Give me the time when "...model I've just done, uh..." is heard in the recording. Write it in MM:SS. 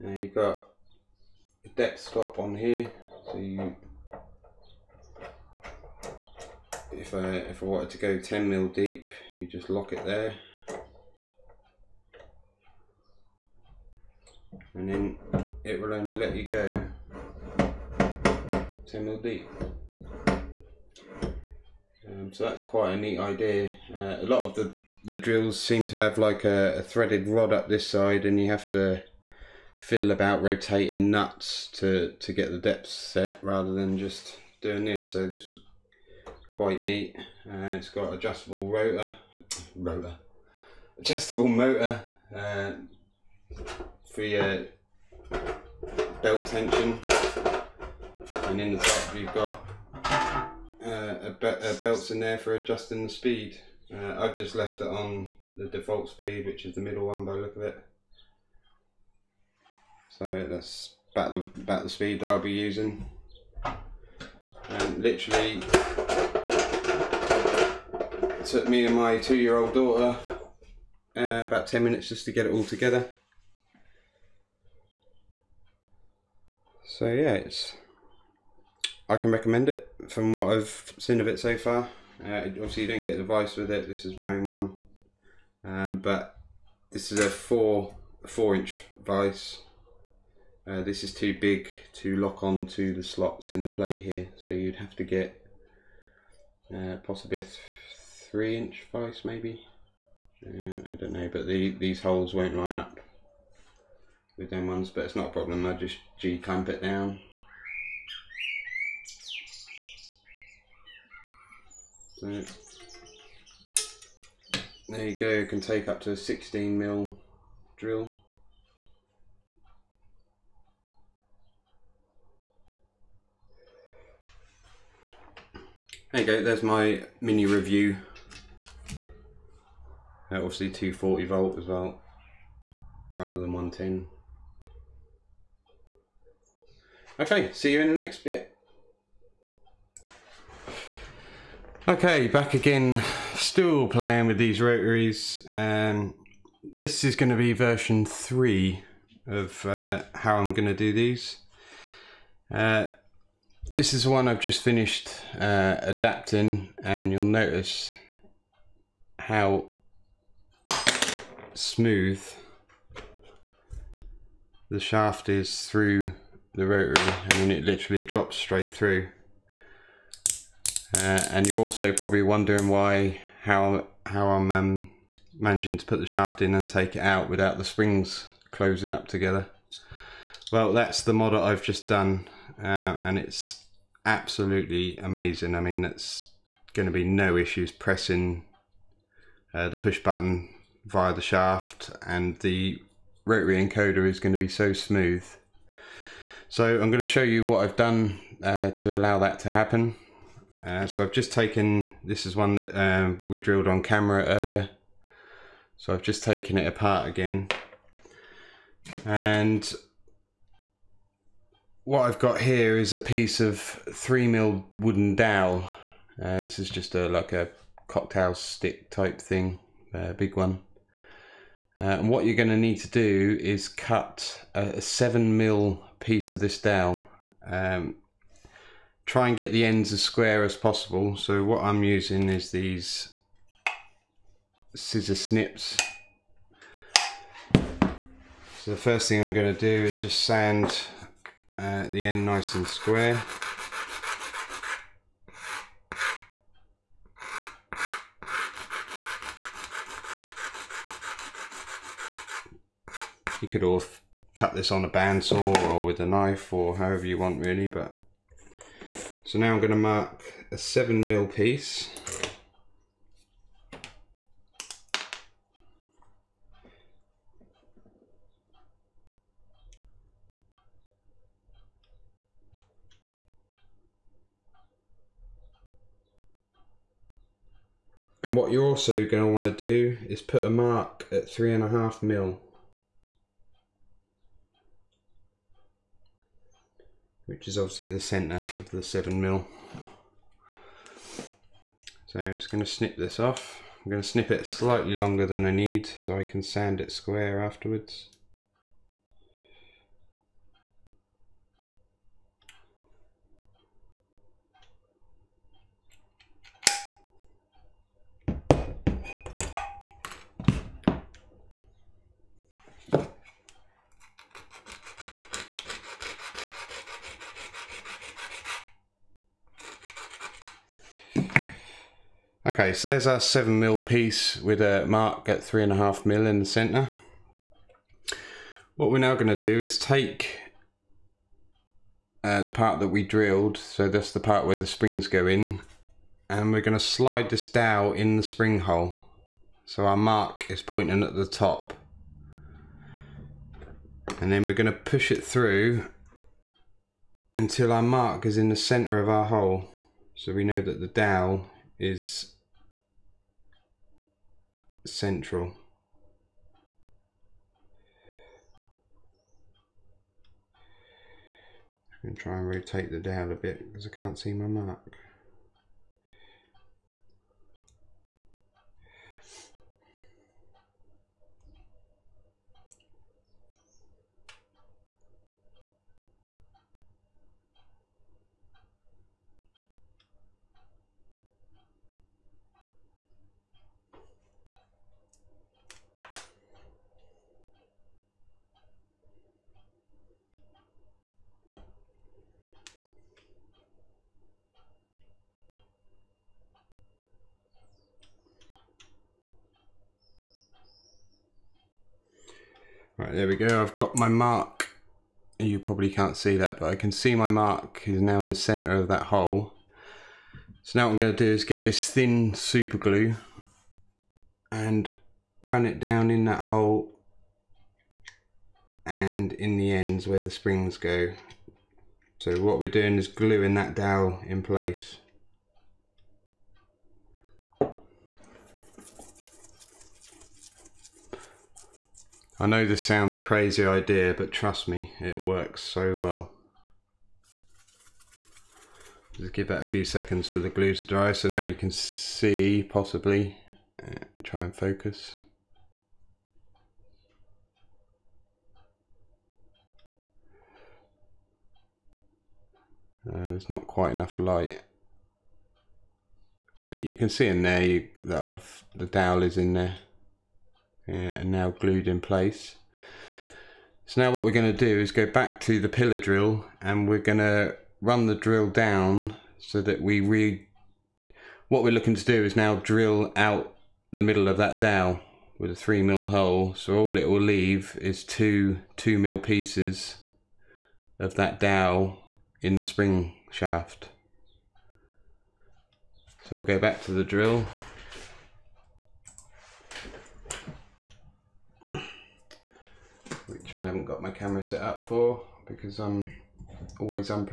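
03:01.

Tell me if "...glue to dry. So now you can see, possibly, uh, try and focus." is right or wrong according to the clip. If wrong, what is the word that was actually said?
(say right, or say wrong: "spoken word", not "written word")
right.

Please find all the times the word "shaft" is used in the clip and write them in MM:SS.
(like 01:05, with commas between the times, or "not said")
02:44, 02:56, 03:11, 08:03.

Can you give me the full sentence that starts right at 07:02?
So what we're doing is gluing that dowel in place.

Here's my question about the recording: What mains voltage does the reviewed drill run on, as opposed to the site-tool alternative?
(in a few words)
240 volt.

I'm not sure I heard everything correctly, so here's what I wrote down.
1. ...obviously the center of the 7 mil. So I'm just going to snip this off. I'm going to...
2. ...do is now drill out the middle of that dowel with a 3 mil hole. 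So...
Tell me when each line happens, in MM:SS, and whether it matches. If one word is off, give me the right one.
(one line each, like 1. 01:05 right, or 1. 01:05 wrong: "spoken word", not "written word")
1. 04:47 right
2. 07:52 right.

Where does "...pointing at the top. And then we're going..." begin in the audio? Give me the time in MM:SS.
05:40.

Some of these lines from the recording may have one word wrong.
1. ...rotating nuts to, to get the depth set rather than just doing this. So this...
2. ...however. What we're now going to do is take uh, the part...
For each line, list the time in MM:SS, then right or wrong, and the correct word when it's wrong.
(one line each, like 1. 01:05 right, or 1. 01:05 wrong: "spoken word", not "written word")
1. 00:30 right
2. 05:26 wrong: "center", not "however".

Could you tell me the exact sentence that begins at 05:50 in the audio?
So we know that the dowel is central.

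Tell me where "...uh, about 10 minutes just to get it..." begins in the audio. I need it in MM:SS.
01:11.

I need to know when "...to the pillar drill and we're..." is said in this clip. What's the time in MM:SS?
07:45.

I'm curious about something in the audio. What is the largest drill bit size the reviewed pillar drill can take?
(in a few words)
16 mm.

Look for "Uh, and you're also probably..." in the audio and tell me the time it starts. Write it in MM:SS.
02:50.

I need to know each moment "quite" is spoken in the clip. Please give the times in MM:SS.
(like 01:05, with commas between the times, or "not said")
00:22, 00:36, 07:33.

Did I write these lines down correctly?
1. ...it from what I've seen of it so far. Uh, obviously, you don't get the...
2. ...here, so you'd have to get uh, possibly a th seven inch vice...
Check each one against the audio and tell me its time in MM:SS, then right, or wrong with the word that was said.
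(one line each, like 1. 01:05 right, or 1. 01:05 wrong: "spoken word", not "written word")
1. 01:19 right
2. 01:34 wrong: "three", not "seven".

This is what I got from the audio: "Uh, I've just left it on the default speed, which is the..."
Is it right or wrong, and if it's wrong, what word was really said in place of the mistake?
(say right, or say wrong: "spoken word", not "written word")
right.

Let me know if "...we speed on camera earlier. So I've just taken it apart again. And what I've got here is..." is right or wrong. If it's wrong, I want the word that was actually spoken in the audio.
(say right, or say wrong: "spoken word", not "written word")
wrong: "drilled", not "speed".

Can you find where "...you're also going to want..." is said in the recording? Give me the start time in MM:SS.
04:38.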